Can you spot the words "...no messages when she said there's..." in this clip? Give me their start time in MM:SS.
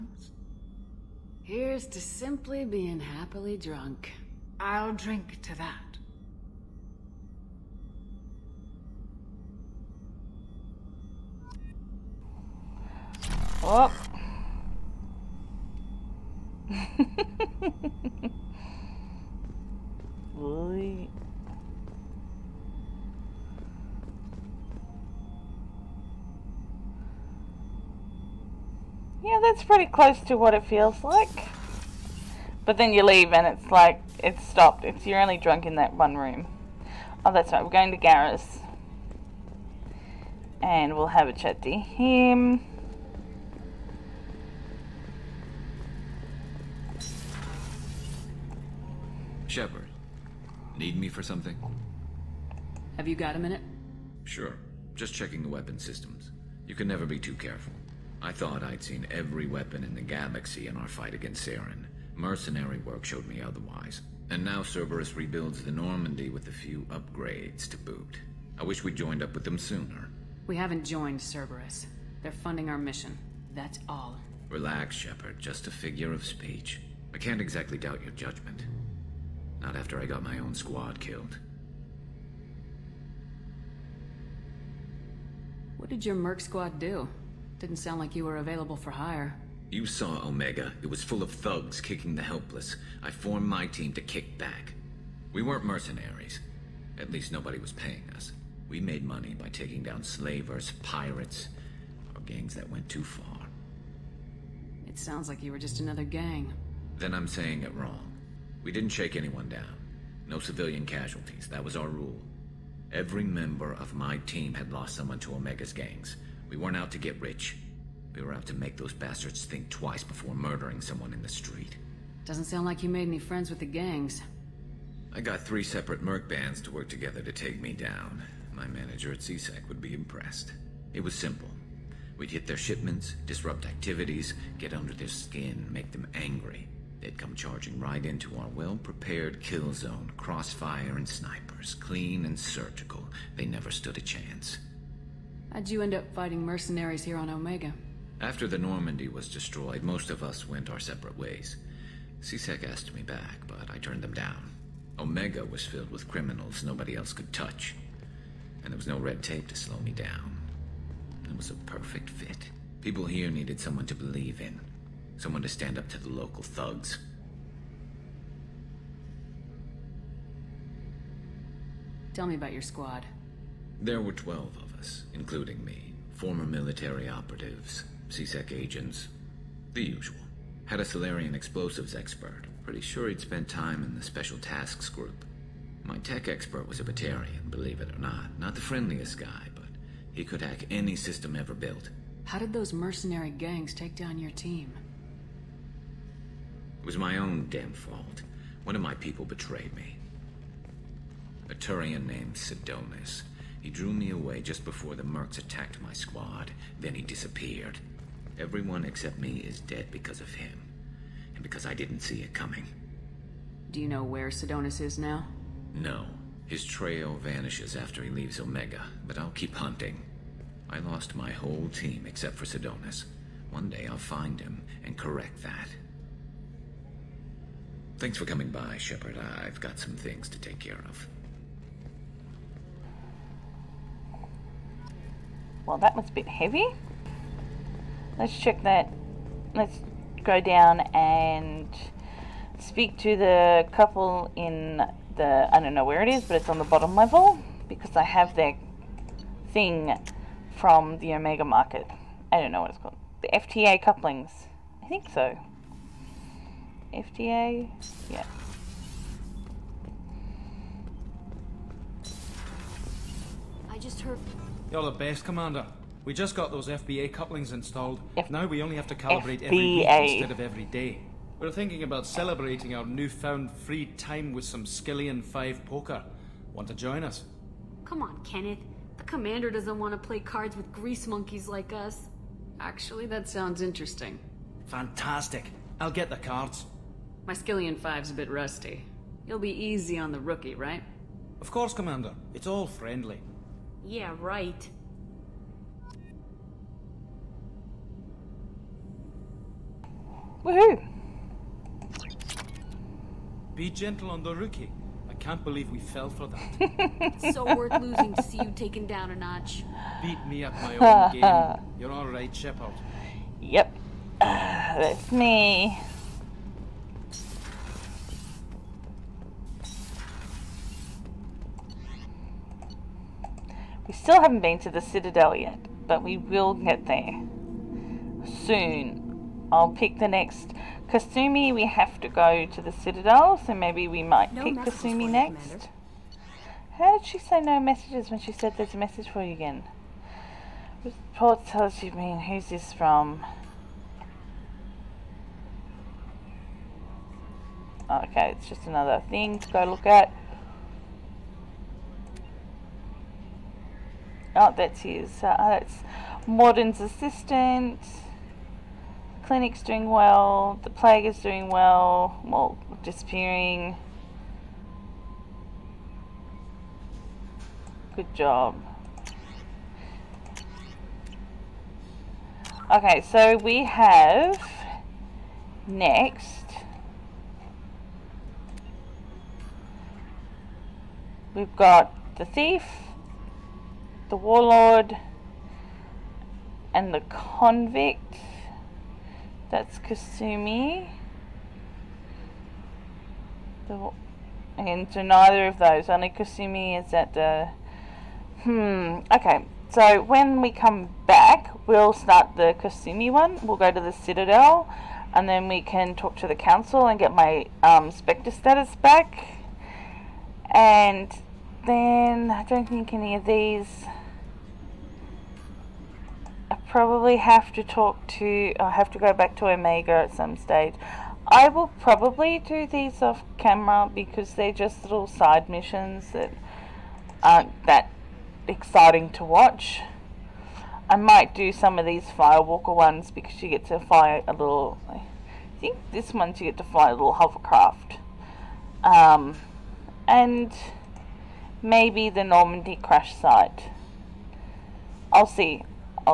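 05:37.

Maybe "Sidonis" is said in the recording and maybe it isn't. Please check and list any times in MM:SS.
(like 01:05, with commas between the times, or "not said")
03:22, 03:34, 03:42.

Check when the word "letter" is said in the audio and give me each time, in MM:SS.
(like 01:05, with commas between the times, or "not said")
not said.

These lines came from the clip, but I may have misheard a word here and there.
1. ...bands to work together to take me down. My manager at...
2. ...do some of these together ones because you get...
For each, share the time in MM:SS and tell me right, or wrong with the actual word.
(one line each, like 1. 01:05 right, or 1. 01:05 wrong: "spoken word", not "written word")
1. 02:06 right
2. 07:11 wrong: "firewalker", not "together".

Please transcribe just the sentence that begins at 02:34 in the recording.
Omega was filled with criminals nobody else could touch.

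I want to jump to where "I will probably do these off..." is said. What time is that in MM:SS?
07:01.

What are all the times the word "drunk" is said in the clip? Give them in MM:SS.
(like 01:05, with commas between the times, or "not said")
00:03, 00:35.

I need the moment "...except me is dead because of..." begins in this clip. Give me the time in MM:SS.
03:28.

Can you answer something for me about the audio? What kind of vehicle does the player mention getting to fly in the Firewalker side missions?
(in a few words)
hovercraft.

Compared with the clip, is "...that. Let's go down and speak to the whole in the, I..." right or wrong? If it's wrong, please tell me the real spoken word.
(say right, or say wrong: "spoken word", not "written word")
wrong: "couple", not "whole".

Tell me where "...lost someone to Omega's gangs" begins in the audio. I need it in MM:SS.
01:54.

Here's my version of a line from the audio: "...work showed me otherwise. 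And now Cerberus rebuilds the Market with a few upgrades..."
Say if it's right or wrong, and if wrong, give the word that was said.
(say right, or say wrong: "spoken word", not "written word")
wrong: "Normandy", not "Market".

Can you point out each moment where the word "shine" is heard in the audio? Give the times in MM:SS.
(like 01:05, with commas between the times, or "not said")
not said.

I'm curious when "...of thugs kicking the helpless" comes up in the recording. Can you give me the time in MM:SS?
01:31.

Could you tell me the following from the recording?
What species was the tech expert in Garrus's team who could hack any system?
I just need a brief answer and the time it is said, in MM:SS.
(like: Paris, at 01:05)
Batarian, at 03:06.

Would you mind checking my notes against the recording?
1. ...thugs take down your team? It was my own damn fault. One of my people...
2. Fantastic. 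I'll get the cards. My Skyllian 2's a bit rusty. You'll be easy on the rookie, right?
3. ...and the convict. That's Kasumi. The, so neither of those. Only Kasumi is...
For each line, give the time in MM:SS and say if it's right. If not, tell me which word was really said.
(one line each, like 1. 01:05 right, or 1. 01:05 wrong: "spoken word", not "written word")
1. 03:13 wrong: "gangs", not "thugs"
2. 04:44 wrong: "5", not "2"
3. 06:26 right.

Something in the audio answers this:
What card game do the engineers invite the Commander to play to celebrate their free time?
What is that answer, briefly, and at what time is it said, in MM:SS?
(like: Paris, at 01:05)
Skyllian 5 poker, at 04:34.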